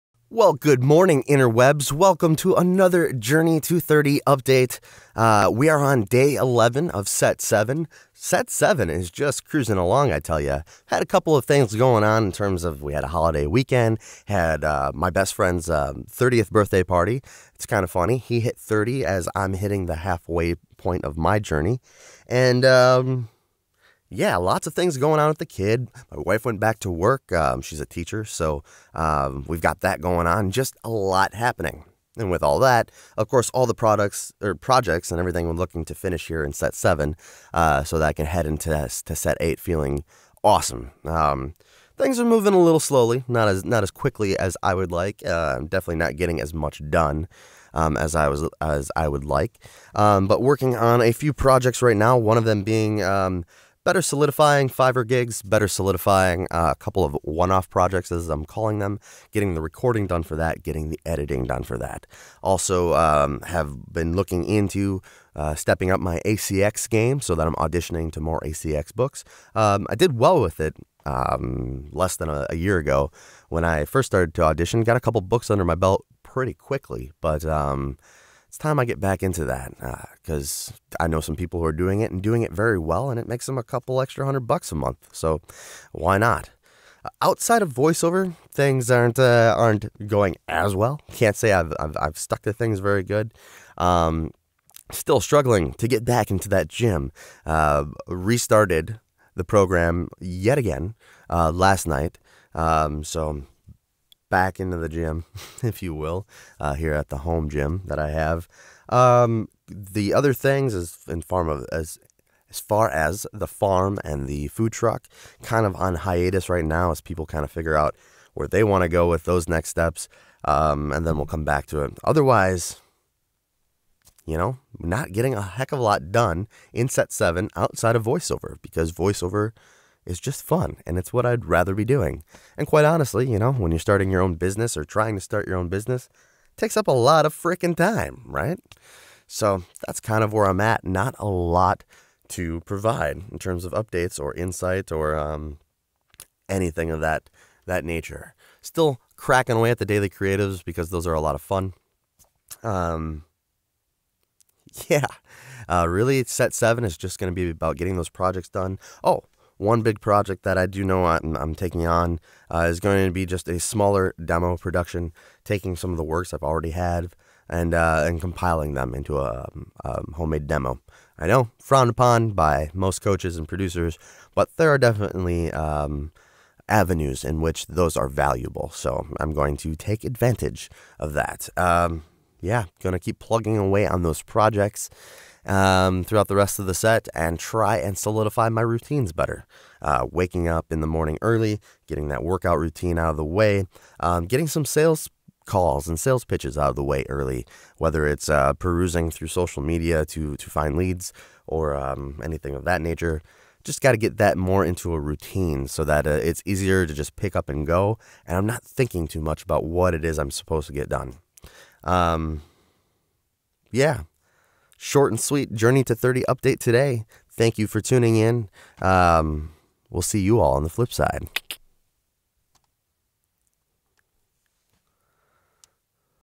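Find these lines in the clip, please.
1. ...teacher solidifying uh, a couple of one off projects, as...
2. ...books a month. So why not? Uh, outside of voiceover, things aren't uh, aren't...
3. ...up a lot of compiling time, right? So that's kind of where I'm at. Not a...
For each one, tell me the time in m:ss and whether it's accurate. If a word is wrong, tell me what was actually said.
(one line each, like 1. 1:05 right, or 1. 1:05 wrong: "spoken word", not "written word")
1. 0:55 wrong: "better", not "teacher"
2. 1:24 wrong: "bucks", not "books"
3. 2:16 wrong: "freaking", not "compiling".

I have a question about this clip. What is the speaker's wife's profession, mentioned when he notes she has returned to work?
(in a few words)
Teacher.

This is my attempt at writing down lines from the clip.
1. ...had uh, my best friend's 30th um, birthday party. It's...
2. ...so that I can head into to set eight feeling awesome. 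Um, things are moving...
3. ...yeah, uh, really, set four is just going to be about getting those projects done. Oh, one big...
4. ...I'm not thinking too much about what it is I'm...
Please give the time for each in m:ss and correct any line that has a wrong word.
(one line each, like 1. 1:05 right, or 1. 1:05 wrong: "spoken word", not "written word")
1. 0:14 right
2. 0:37 right
3. 2:34 wrong: "seven", not "four"
4. 3:28 right.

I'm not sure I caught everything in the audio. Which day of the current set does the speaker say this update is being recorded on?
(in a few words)
Day 11.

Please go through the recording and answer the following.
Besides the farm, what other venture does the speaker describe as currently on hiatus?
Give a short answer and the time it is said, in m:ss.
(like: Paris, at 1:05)
Food truck, at 1:54.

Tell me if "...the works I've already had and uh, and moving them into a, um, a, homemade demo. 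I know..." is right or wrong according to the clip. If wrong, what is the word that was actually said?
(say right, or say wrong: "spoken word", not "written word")
wrong: "compiling", not "moving".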